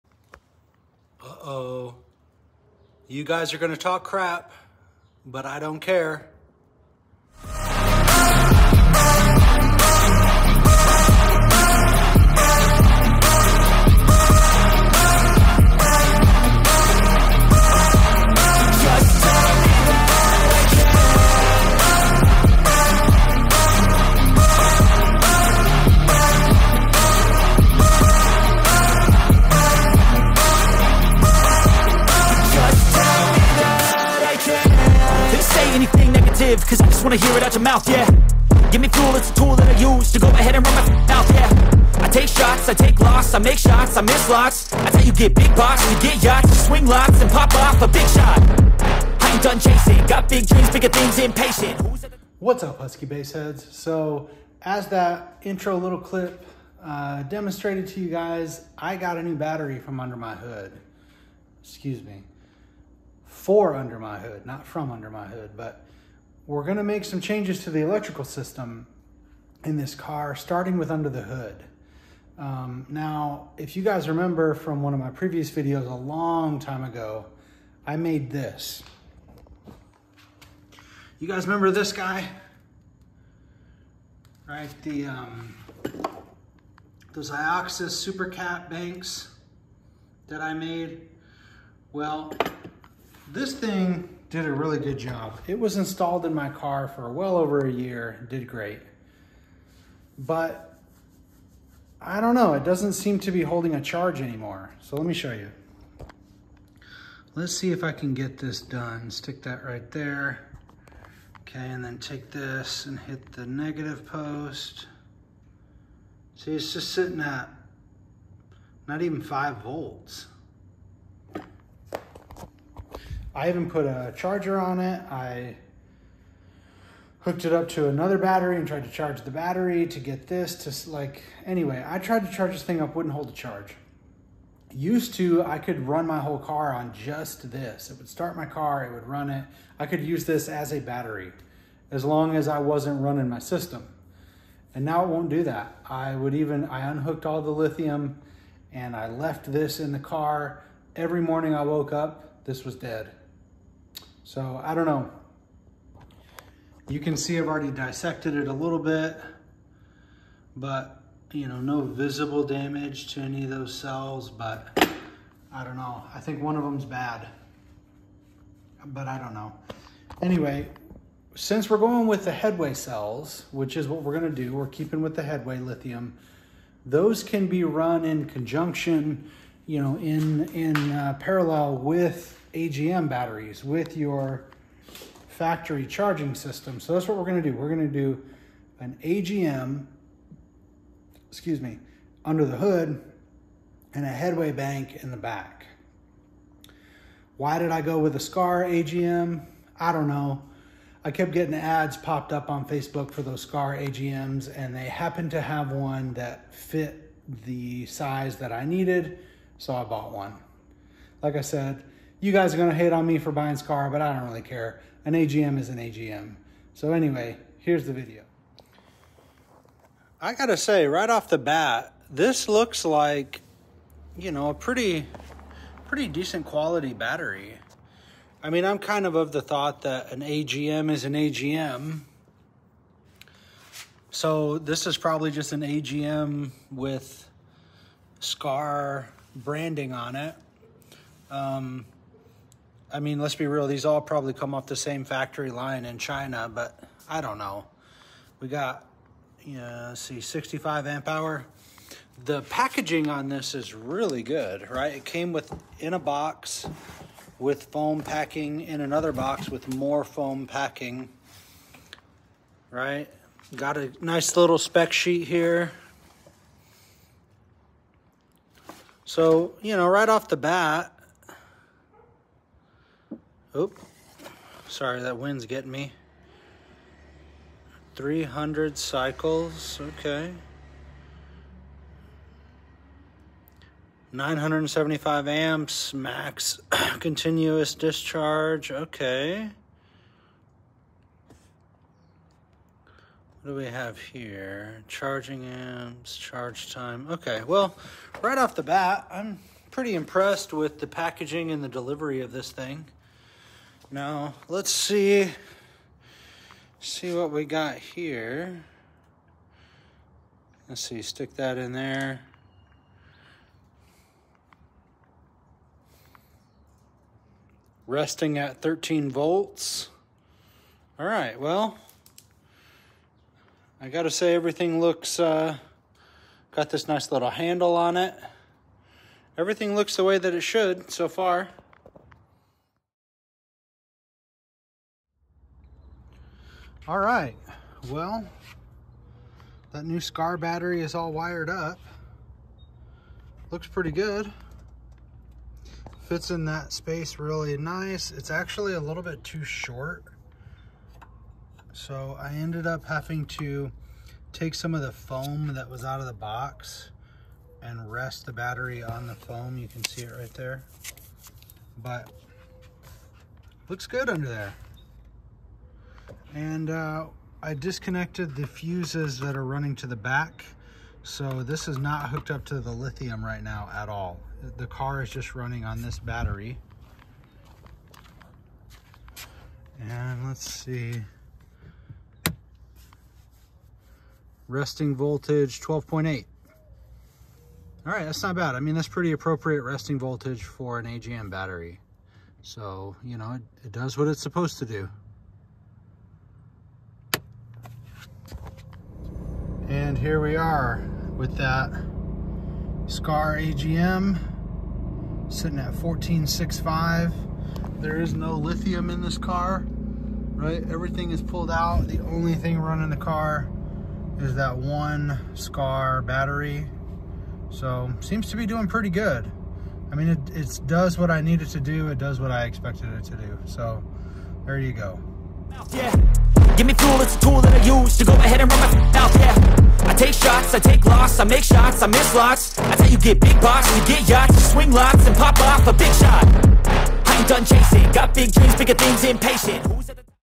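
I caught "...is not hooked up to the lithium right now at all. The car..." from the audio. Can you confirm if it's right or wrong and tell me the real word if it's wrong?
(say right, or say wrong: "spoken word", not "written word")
right.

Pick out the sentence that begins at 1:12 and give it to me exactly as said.
Um, now, if you guys remember from one of my previous videos a long time ago, I made this.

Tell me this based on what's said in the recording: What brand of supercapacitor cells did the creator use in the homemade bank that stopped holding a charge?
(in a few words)
Ioxus.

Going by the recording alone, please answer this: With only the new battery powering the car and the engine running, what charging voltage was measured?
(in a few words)
14.65.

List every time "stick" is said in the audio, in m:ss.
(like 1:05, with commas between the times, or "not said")
1:49, 5:11.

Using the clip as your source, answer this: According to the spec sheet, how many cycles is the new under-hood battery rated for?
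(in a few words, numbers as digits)
300.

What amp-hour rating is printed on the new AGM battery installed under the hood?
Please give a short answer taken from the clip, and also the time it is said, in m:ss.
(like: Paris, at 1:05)
65 amp hour, at 4:10.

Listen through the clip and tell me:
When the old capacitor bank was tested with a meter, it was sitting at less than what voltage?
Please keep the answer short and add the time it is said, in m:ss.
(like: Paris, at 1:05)
5 volts, at 1:59.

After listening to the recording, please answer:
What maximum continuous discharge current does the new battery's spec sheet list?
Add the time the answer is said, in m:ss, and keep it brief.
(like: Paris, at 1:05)
975 amps, at 4:44.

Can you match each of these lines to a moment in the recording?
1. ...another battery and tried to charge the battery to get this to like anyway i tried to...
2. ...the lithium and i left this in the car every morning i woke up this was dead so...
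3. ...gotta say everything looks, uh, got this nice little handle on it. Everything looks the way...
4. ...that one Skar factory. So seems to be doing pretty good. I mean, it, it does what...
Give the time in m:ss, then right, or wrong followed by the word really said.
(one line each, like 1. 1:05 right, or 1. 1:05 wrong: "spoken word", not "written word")
1. 2:07 right
2. 2:27 right
3. 5:23 right
4. 6:54 wrong: "battery", not "factory".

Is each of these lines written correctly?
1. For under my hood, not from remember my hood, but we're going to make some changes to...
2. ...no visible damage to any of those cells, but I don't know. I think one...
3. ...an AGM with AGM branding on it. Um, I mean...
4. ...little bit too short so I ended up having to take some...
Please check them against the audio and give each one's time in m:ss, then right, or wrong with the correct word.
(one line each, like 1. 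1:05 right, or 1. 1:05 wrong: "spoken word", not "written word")
1. 1:03 wrong: "under", not "remember"
2. 2:41 right
3. 3:55 wrong: "Skar", not "AGM"
4. 5:48 right.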